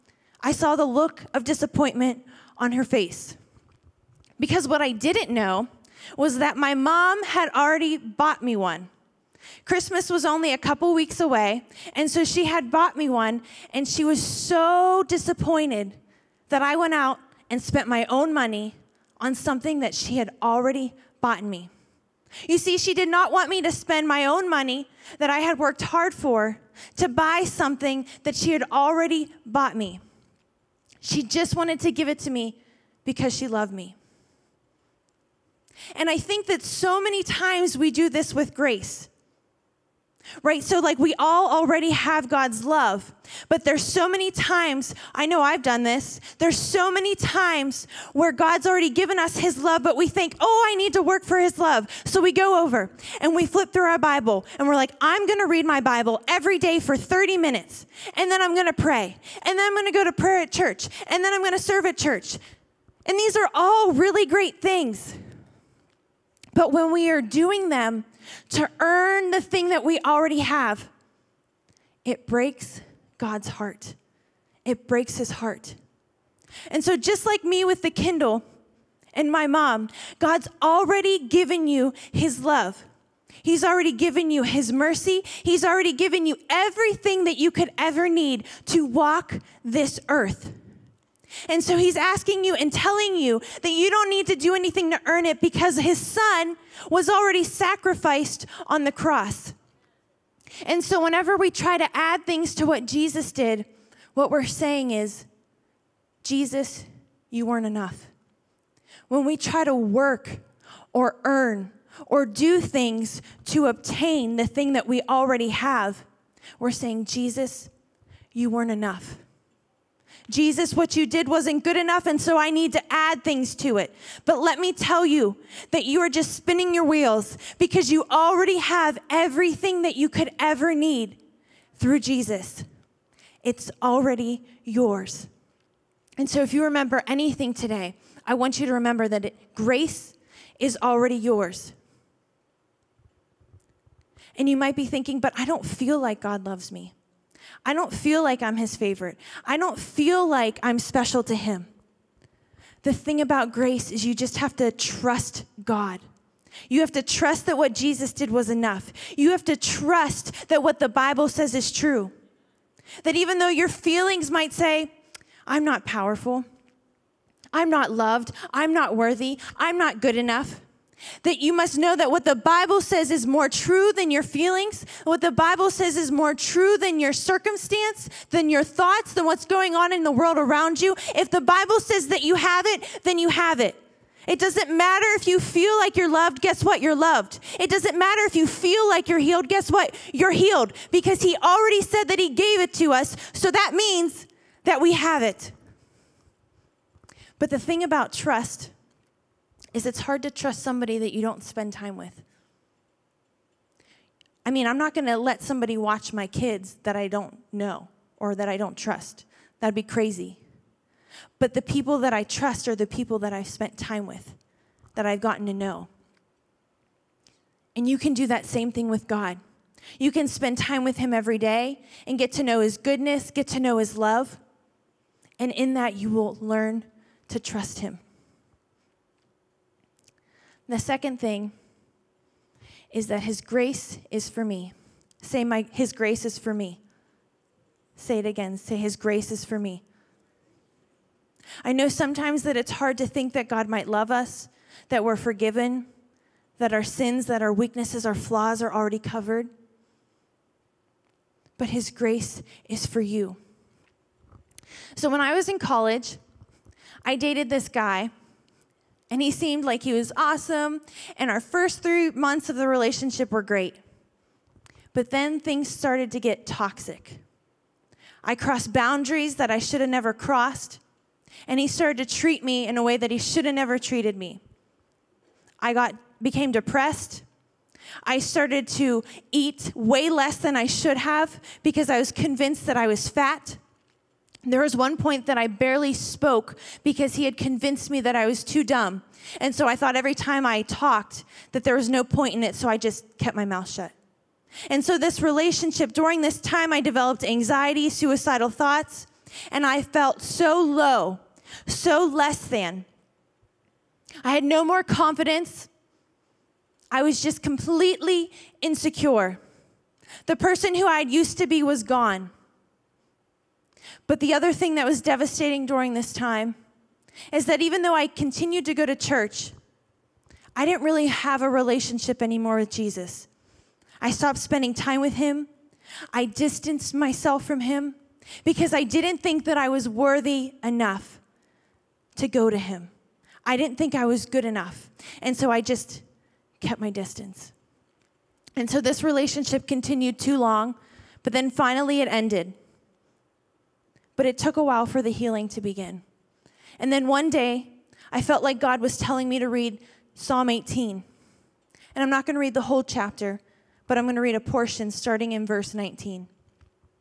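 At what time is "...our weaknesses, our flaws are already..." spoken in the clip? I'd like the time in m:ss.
4:07.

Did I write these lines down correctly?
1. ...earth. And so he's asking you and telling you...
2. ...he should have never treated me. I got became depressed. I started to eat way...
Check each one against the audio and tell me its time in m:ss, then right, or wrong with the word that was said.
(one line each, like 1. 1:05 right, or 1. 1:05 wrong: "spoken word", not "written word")
1. 1:30 right
2. 4:33 right.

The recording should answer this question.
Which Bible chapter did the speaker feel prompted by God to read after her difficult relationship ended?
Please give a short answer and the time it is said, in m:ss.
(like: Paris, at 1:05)
Psalm 18, at 5:50.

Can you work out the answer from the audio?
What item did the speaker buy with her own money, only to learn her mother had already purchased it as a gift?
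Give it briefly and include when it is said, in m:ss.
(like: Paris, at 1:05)
Kindle, at 1:17.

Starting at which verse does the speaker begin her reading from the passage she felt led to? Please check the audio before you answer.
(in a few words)
19.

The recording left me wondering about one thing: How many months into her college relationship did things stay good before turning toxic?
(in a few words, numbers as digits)
3.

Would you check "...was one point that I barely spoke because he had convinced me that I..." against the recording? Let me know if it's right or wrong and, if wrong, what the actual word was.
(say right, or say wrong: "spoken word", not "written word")
right.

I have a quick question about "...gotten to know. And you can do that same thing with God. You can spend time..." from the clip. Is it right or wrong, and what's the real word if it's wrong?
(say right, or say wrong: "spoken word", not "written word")
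right.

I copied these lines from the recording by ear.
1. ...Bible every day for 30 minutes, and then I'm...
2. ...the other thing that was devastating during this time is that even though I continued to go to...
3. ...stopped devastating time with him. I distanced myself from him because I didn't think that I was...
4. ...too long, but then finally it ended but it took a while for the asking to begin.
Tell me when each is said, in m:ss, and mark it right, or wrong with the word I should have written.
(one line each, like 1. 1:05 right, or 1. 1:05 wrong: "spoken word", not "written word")
1. 0:55 right
2. 5:14 right
3. 5:24 wrong: "spending", not "devastating"
4. 5:40 wrong: "healing", not "asking".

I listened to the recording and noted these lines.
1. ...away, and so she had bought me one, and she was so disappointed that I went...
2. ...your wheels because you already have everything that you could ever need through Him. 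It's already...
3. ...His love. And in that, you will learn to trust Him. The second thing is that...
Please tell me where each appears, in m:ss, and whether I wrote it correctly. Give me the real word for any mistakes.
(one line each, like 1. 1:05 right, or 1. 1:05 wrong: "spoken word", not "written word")
1. 0:11 right
2. 2:06 wrong: "Jesus", not "Him"
3. 3:43 right.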